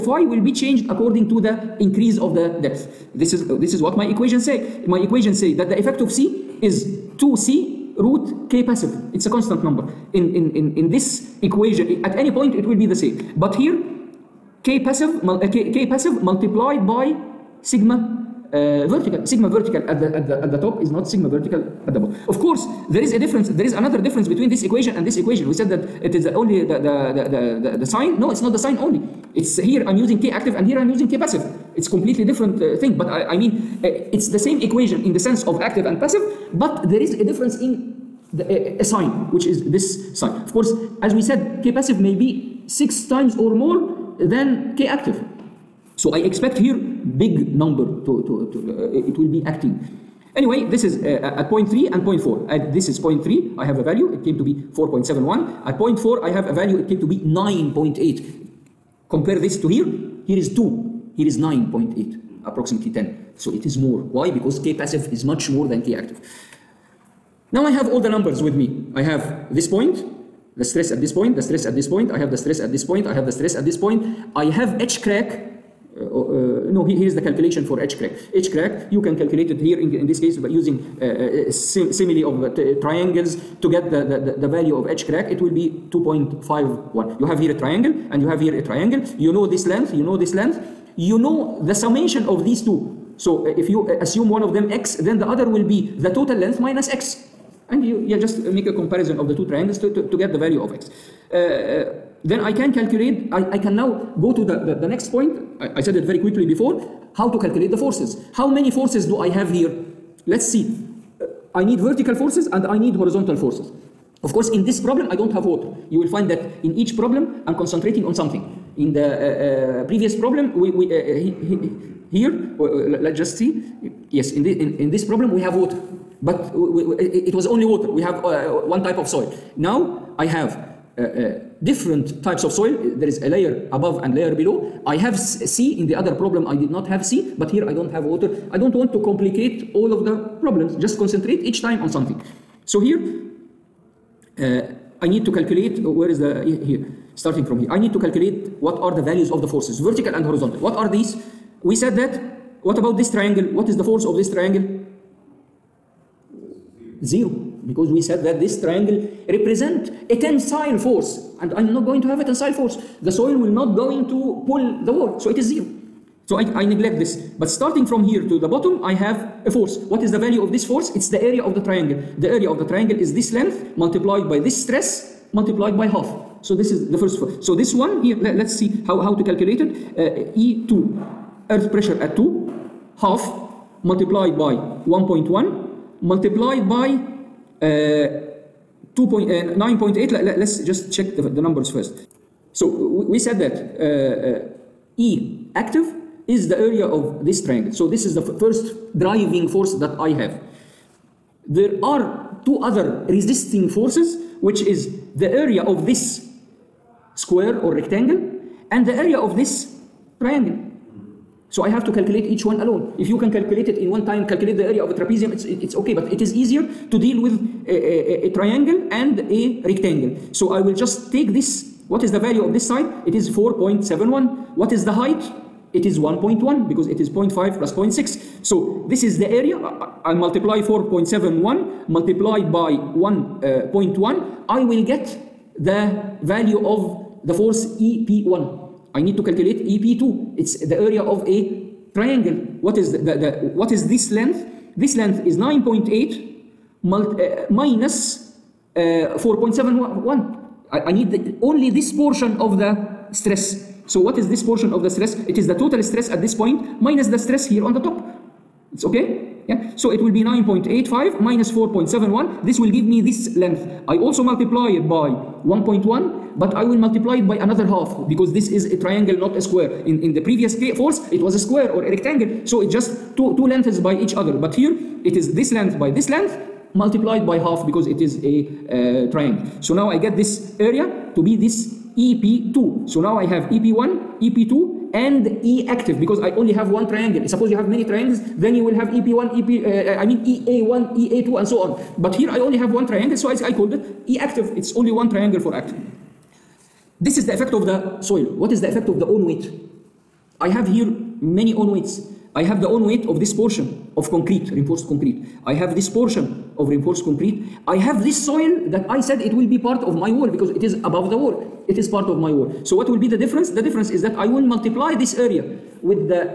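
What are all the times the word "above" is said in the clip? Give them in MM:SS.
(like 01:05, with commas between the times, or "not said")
02:13, 05:10.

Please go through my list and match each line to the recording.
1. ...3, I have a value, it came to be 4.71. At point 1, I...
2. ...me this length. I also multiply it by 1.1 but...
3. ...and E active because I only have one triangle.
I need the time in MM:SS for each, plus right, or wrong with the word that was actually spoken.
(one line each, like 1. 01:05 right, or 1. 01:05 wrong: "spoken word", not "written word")
1. 00:53 wrong: "4", not "1"
2. 04:22 right
3. 04:44 right.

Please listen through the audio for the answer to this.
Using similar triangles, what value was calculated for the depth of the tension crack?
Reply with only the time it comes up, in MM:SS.
01:25.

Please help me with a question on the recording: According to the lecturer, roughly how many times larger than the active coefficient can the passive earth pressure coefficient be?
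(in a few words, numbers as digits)
6 times.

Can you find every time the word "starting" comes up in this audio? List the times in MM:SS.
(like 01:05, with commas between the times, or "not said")
02:27, 02:47.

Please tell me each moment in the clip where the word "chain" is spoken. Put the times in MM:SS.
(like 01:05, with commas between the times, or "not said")
not said.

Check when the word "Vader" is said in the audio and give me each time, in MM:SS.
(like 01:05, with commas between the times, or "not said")
not said.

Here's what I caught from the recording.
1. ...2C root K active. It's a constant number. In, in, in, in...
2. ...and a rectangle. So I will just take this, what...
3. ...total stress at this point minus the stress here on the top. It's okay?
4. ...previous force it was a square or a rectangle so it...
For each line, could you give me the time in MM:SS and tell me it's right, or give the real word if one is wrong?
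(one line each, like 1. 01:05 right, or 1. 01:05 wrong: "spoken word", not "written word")
1. 00:07 wrong: "passive", not "active"
2. 03:38 right
3. 04:15 right
4. 04:30 right.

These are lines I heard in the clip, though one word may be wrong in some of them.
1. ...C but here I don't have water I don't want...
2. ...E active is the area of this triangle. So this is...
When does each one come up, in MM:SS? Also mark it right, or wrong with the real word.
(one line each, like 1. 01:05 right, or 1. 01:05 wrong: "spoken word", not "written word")
1. 02:17 right
2. 03:14 right.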